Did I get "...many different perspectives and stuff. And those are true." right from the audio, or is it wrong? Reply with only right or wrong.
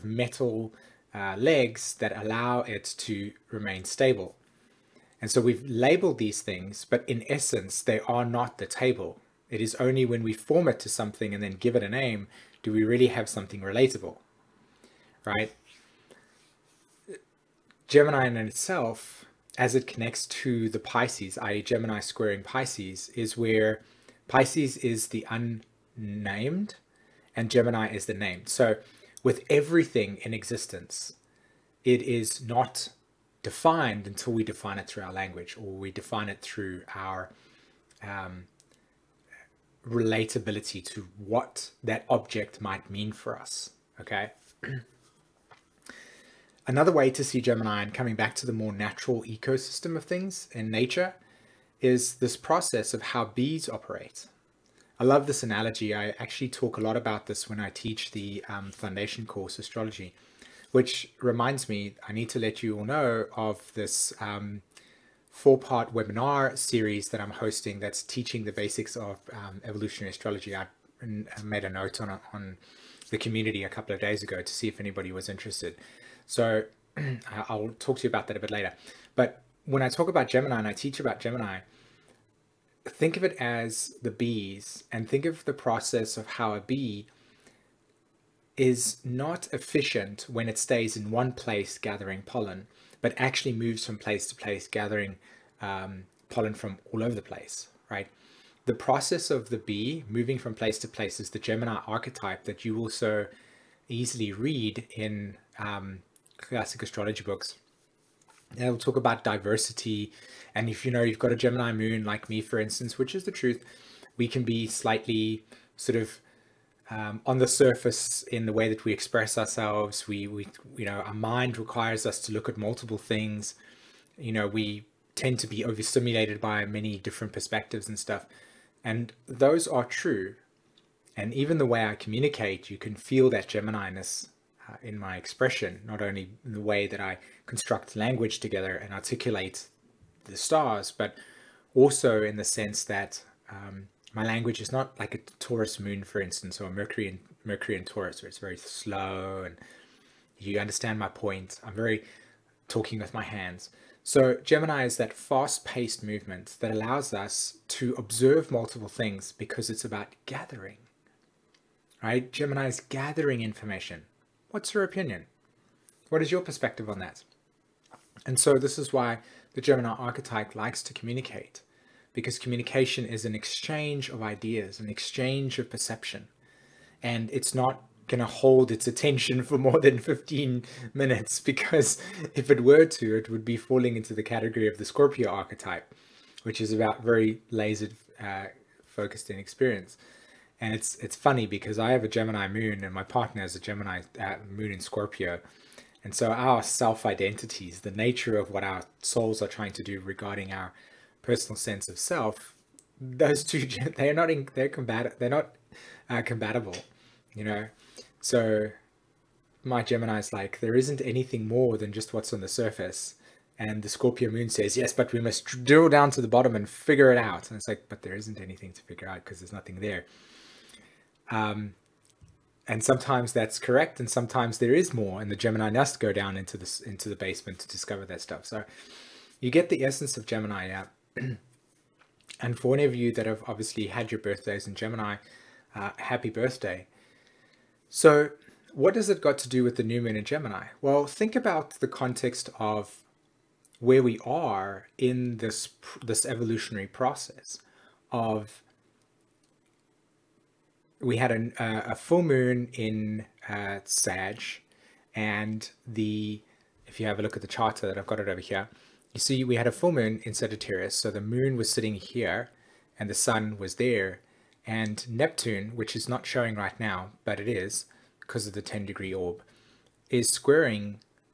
right.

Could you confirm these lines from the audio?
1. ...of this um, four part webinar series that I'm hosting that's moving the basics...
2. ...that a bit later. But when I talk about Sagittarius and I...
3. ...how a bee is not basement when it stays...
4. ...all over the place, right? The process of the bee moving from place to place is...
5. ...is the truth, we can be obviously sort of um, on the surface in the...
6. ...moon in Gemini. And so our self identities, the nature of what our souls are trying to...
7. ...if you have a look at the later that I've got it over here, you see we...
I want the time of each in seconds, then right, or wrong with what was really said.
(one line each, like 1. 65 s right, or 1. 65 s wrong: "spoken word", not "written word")
1. 63 s wrong: "teaching", not "moving"
2. 78 s wrong: "Gemini", not "Sagittarius"
3. 86 s wrong: "efficient", not "basement"
4. 96 s right
5. 113 s wrong: "slightly", not "obviously"
6. 194 s wrong: "Scorpio", not "Gemini"
7. 256 s wrong: "charter", not "later".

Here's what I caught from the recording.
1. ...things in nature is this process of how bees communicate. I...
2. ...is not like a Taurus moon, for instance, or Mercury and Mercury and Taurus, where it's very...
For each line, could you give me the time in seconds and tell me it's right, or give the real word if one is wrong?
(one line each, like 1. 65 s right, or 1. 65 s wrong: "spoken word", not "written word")
1. 50 s wrong: "operate", not "communicate"
2. 144 s right.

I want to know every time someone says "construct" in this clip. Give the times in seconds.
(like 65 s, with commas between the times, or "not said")
137 s.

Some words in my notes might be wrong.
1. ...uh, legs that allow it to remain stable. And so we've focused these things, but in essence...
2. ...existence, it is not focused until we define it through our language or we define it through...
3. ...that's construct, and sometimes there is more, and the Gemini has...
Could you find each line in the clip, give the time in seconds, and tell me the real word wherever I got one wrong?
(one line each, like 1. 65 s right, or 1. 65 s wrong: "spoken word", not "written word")
1. 1 s wrong: "labeled", not "focused"
2. 30 s wrong: "defined", not "focused"
3. 223 s wrong: "correct", not "construct".